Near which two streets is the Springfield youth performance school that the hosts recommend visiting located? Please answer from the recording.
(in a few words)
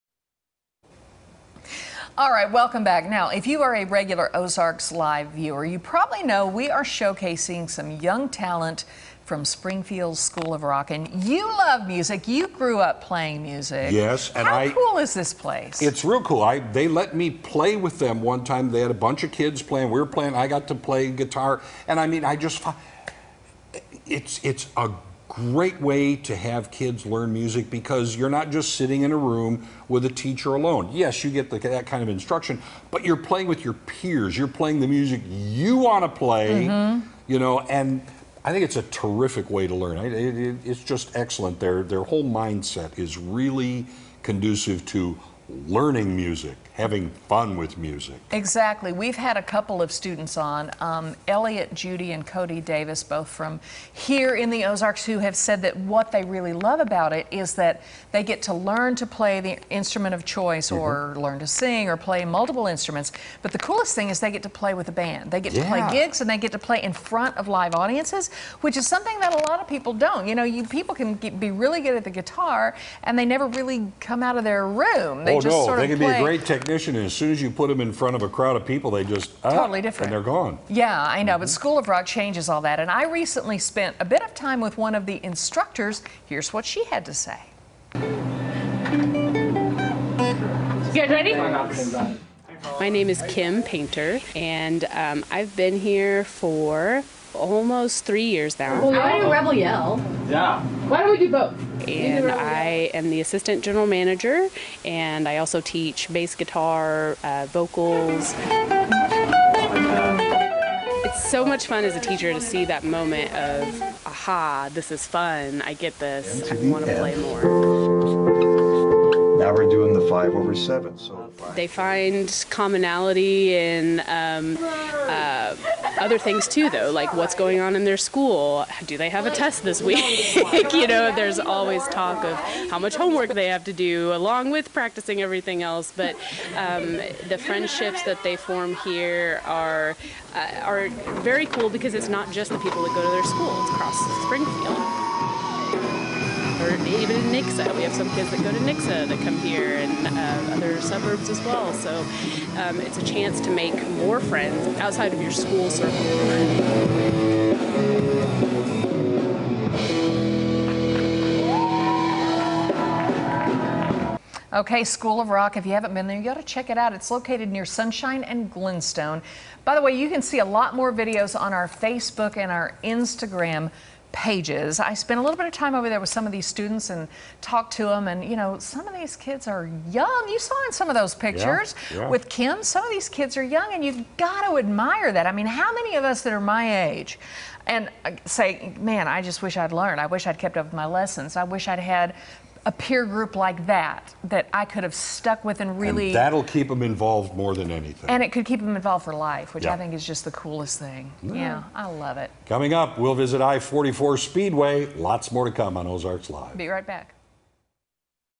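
Sunshine and Glenstone.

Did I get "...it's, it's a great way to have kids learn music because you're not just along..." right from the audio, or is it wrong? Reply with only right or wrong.
wrong.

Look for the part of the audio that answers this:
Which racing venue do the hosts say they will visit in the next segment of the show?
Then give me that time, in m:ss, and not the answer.
3:23.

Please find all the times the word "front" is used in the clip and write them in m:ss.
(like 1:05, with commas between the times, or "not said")
1:07, 1:17.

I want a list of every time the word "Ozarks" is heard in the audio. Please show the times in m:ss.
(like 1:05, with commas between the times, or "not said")
0:04, 0:54, 3:25.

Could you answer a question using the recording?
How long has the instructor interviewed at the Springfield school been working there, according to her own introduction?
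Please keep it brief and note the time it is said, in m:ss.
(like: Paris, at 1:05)
almost 3 years, at 1:37.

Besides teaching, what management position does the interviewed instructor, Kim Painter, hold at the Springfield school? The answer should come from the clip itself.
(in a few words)
assistant general manager.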